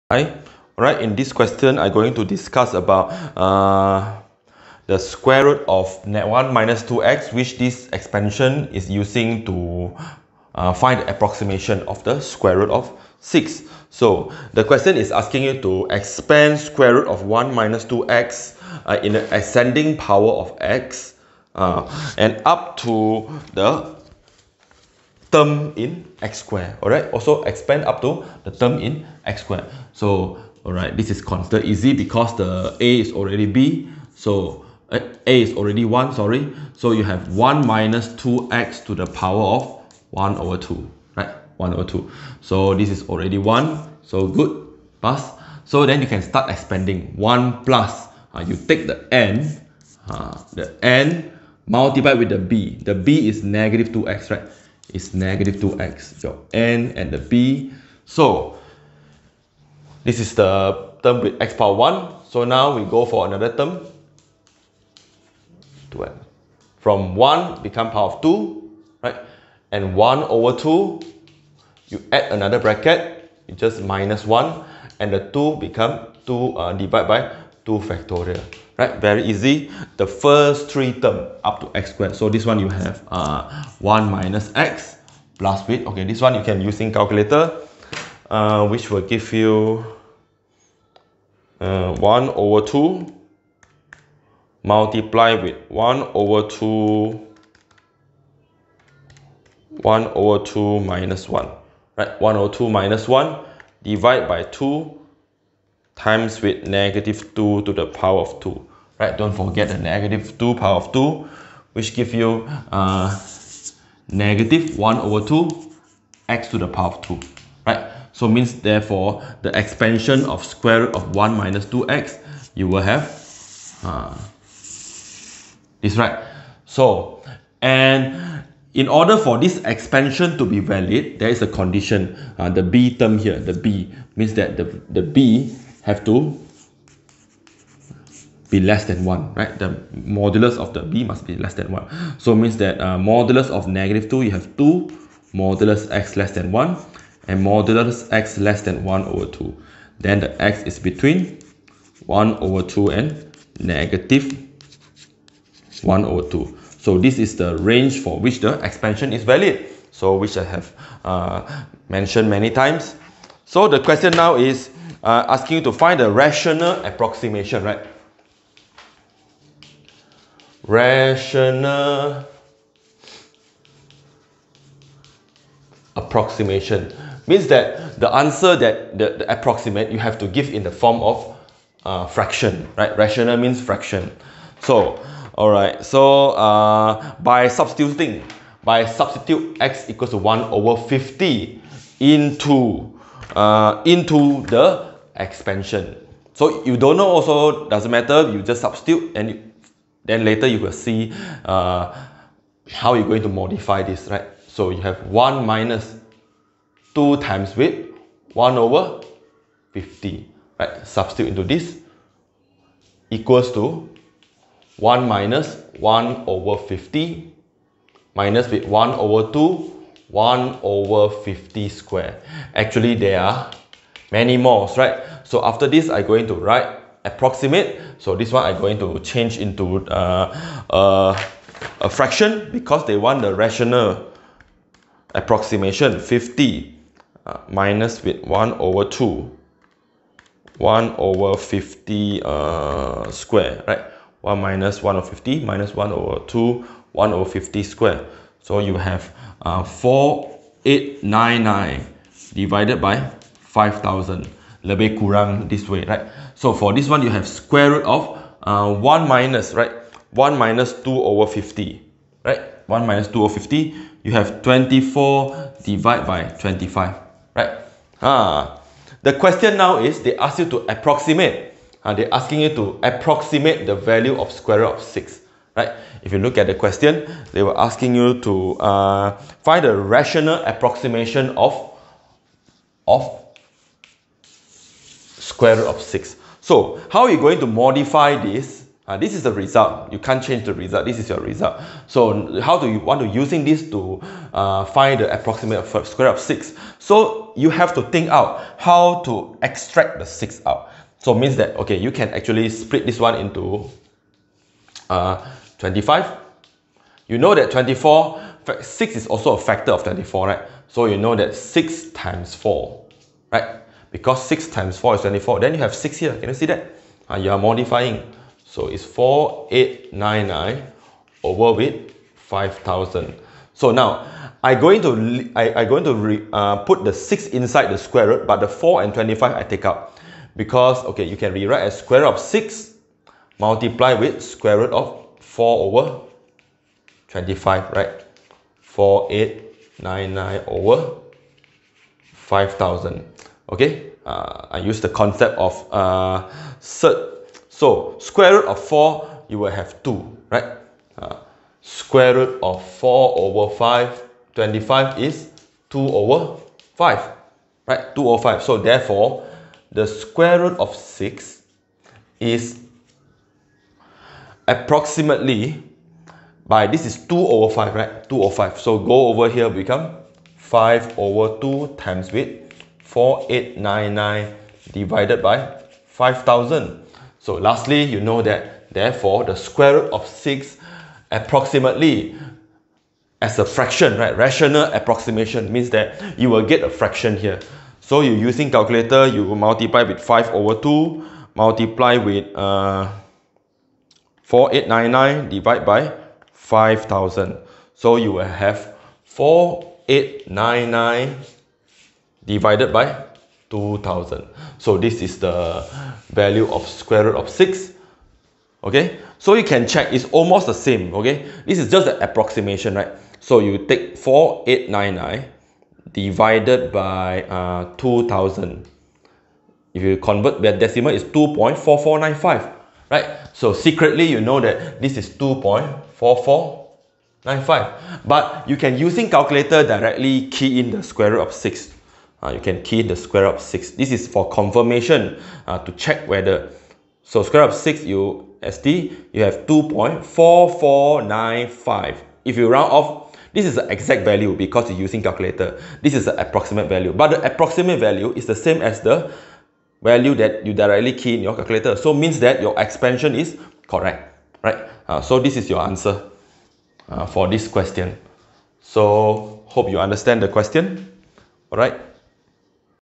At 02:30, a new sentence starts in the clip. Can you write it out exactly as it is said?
Then the x is between 1 over 2 and negative 1 over 2.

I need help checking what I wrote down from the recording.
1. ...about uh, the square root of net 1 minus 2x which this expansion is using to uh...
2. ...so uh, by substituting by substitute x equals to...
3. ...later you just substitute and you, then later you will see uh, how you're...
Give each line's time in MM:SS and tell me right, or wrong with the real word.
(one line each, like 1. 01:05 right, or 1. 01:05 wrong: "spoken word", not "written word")
1. 00:02 right
2. 03:05 right
3. 03:17 wrong: "matter", not "later".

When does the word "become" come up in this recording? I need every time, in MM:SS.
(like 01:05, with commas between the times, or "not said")
01:07, 01:15, 06:09.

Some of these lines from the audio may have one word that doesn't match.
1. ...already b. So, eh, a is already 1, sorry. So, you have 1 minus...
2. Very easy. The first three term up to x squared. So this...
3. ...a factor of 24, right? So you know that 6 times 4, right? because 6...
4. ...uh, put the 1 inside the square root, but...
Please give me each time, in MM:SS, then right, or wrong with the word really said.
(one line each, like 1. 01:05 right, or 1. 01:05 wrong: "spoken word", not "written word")
1. 00:33 right
2. 01:19 right
3. 05:09 right
4. 05:26 wrong: "6", not "1".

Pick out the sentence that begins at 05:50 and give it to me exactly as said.
Uh, square root of 4 over 5, 25 is 2 over 5, right?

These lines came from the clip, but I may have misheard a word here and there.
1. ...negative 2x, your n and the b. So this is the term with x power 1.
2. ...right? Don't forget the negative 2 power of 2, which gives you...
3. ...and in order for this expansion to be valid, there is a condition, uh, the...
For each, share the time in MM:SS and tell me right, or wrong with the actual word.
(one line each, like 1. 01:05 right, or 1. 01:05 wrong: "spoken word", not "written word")
1. 00:55 right
2. 01:49 right
3. 02:07 right.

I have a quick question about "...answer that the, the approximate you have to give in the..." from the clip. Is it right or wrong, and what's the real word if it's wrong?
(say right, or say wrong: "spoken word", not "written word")
right.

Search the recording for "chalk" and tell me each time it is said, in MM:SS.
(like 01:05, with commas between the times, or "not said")
not said.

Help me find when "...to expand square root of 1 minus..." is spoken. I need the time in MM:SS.
00:15.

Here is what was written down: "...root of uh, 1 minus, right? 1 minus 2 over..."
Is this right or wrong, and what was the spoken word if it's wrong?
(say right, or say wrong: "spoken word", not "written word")
right.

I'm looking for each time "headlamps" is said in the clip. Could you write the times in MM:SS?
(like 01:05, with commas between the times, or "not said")
not said.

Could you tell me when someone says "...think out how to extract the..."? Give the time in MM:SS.
04:57.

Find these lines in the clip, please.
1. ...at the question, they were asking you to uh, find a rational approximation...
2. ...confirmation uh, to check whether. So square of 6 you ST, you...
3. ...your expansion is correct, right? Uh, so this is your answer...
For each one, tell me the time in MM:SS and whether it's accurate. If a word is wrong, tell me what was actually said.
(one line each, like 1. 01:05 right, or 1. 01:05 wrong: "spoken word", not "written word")
1. 04:36 right
2. 07:14 right
3. 07:32 right.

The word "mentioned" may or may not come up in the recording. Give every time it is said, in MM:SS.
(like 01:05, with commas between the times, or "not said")
02:41.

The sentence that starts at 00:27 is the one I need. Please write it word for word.
Also expand up to the term in x squared.